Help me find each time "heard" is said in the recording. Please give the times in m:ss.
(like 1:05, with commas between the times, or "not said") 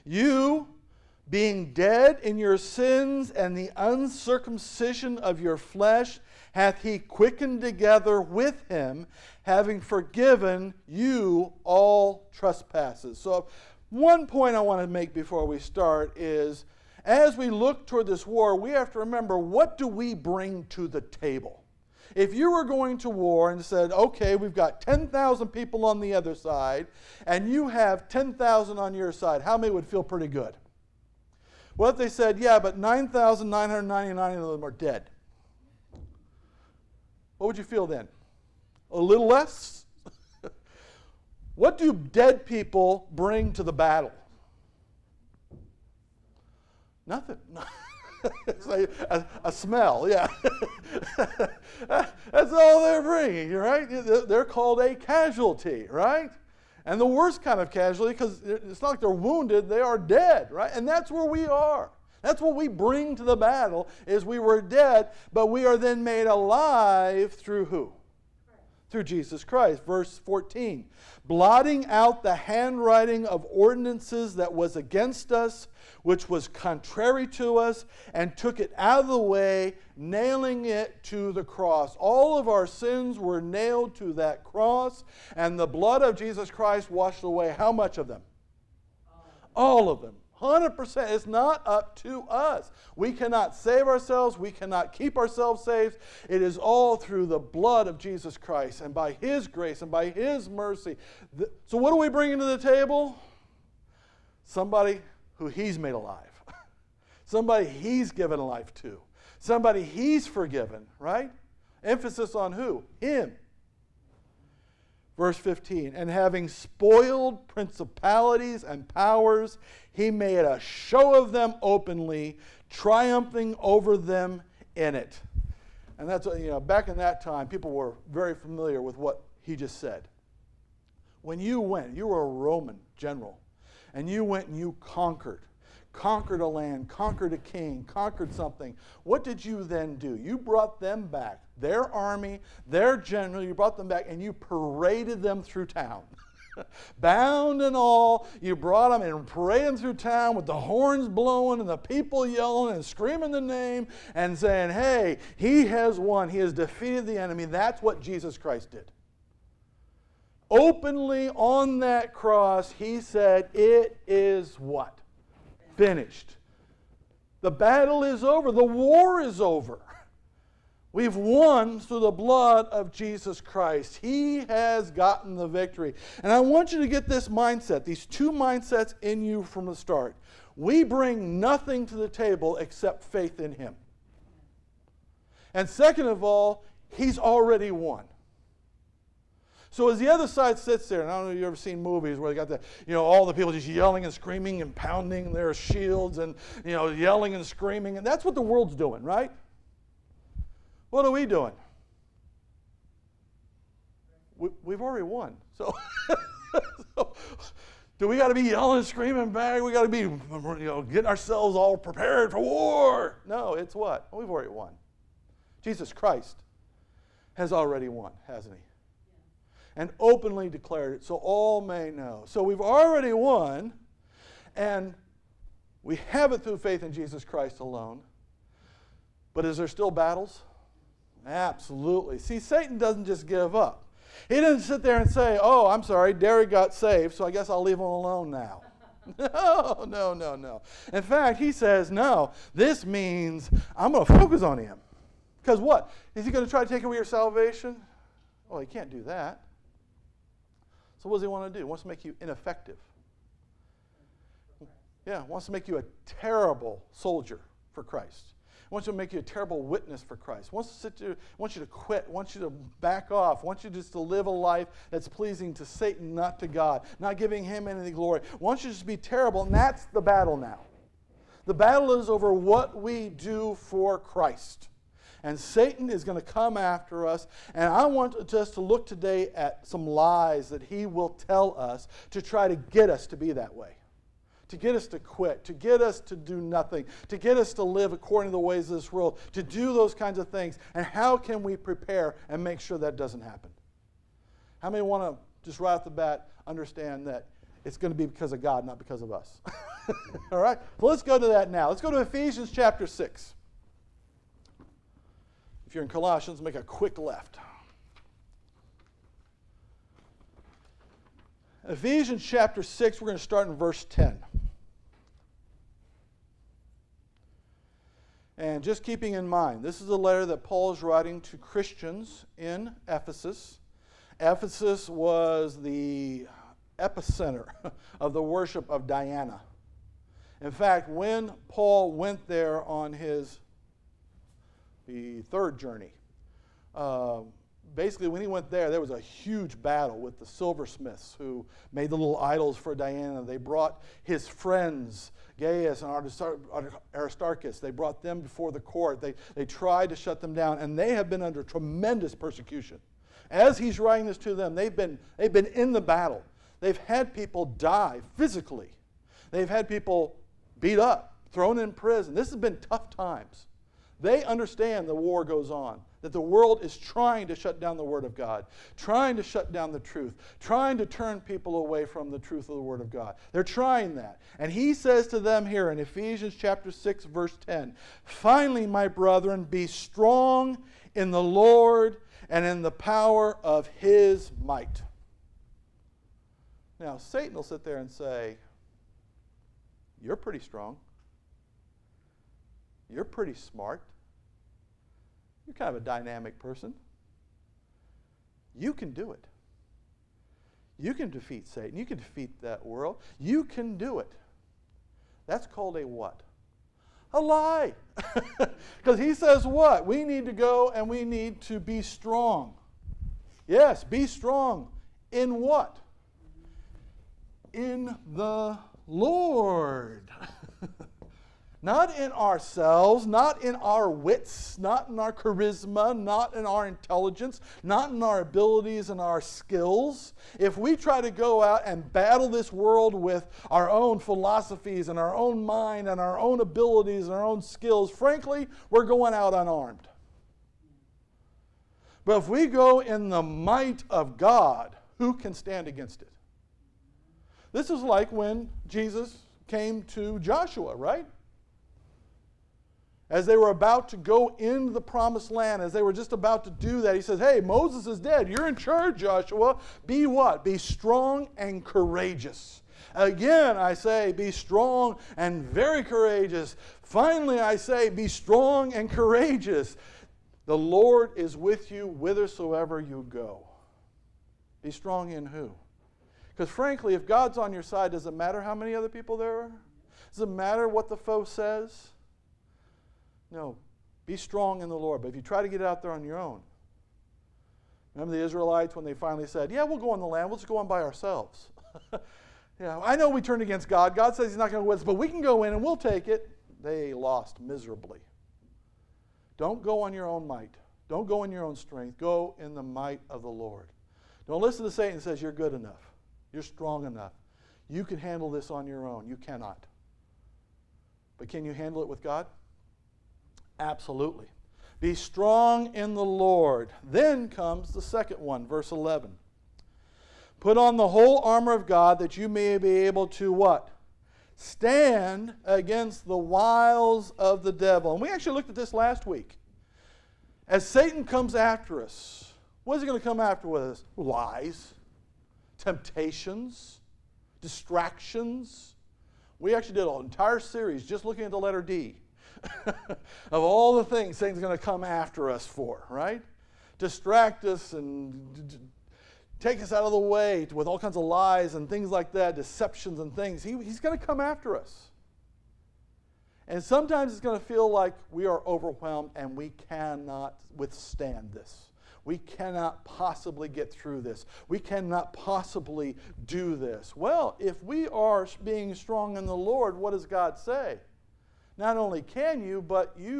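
not said.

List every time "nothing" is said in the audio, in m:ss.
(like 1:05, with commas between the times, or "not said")
0:47, 3:01, 4:46.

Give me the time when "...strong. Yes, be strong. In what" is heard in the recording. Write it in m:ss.
6:51.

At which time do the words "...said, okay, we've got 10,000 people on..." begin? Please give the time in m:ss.
0:23.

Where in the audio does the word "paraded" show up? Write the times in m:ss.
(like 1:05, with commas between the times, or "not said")
2:24, 2:29.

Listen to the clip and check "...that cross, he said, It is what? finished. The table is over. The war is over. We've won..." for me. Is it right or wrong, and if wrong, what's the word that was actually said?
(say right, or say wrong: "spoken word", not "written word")
wrong: "battle", not "table".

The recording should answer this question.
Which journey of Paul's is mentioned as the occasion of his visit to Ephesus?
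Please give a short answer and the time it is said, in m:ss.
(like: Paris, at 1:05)
the third journey, at 5:34.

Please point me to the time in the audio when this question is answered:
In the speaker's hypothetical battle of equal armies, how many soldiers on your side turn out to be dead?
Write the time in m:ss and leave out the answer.
0:32.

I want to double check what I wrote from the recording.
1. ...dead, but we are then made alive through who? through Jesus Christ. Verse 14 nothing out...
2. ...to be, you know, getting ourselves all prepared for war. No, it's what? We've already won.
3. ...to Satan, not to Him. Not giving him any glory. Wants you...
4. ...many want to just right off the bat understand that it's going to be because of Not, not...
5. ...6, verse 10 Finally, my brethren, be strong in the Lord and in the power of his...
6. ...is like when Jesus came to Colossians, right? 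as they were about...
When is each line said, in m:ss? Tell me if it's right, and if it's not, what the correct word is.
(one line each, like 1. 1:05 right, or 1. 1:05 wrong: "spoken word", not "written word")
1. 1:04 wrong: "blotting", not "nothing"
2. 3:29 right
3. 4:25 wrong: "God", not "Him"
4. 4:54 wrong: "God", not "Not"
5. 6:16 right
6. 7:27 wrong: "Joshua", not "Colossians".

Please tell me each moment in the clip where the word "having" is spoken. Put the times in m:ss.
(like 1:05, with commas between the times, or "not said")
0:09, 1:56.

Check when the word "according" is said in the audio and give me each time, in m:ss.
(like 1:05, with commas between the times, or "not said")
4:47.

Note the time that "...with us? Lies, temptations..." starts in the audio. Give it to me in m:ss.
8:53.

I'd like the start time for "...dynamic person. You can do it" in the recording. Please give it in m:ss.
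6:35.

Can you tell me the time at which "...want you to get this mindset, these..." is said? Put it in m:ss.
2:56.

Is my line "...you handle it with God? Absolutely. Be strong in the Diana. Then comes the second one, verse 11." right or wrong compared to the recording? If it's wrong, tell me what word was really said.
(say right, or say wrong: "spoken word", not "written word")
wrong: "Lord", not "Diana".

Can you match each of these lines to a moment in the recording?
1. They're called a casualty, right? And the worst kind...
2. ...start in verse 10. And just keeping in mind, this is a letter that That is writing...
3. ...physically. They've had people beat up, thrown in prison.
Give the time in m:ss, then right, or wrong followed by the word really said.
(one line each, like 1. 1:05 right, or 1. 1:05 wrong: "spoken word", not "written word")
1. 0:53 right
2. 5:13 wrong: "Paul", not "That"
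3. 5:58 right.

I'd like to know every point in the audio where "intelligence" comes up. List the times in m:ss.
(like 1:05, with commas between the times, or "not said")
7:06.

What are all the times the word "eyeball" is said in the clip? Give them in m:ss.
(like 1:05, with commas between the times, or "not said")
not said.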